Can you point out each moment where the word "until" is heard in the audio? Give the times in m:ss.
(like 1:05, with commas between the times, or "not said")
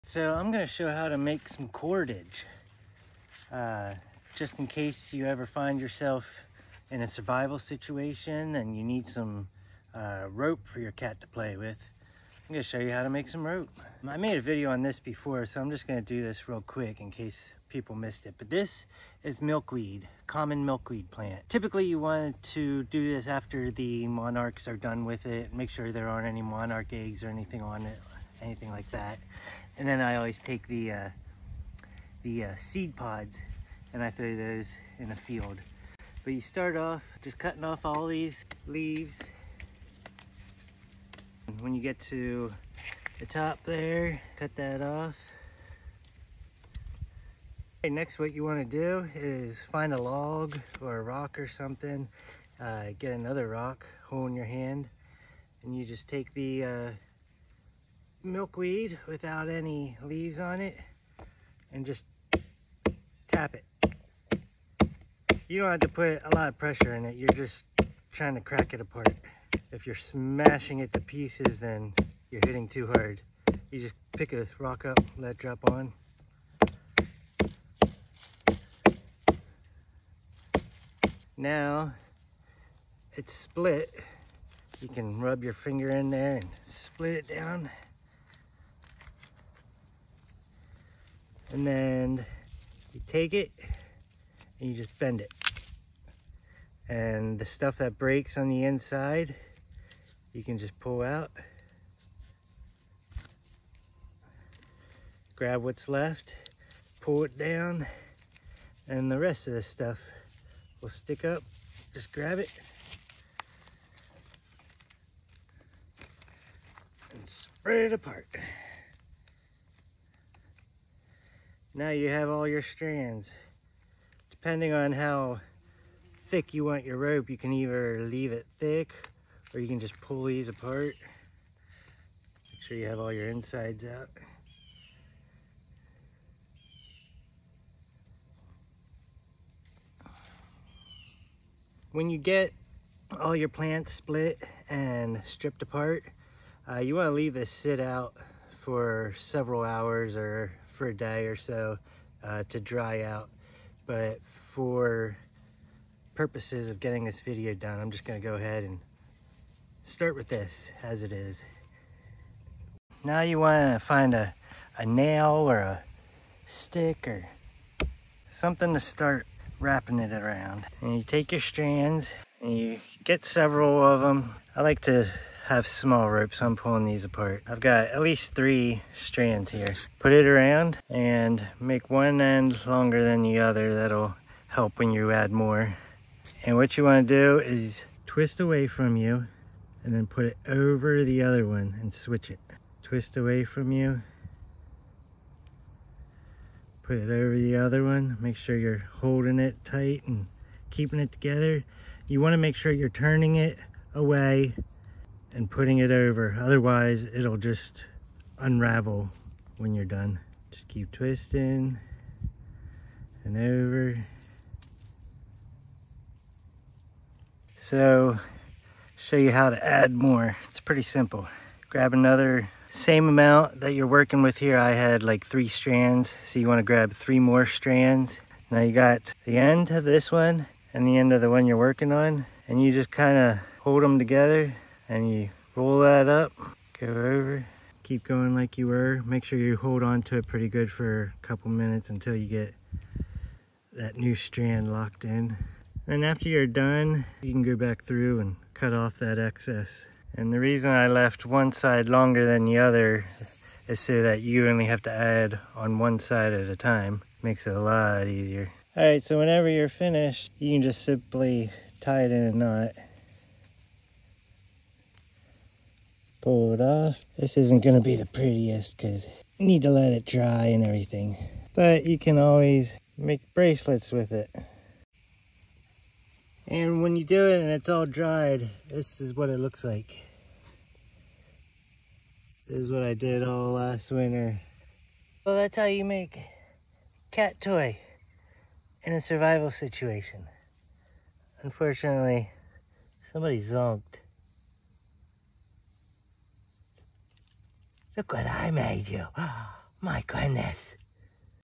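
4:01.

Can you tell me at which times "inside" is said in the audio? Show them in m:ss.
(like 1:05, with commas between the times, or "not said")
1:38, 2:13.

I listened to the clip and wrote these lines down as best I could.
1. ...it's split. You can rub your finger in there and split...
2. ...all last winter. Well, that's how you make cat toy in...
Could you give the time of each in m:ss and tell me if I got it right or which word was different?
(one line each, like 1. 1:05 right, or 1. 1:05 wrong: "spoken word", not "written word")
1. 1:23 right
2. 4:43 right.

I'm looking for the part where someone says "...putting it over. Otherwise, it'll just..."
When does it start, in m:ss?
3:25.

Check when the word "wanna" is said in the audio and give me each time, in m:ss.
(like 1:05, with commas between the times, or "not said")
2:43, 3:06, 3:22, 3:46.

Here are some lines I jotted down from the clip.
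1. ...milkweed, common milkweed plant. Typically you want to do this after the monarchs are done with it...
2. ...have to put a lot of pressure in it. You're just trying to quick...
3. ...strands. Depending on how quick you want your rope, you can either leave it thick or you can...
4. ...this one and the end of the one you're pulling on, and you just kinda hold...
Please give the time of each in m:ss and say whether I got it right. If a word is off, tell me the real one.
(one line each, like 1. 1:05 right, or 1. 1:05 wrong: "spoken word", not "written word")
1. 0:19 right
2. 1:05 wrong: "crack", not "quick"
3. 2:02 wrong: "thick", not "quick"
4. 3:49 wrong: "working", not "pulling".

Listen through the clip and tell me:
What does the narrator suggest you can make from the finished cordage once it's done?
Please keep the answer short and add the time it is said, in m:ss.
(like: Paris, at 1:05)
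Bracelets, at 4:33.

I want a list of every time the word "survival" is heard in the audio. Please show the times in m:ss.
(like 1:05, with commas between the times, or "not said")
0:07, 4:49.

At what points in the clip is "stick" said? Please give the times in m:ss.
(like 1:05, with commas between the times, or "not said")
1:50, 2:46.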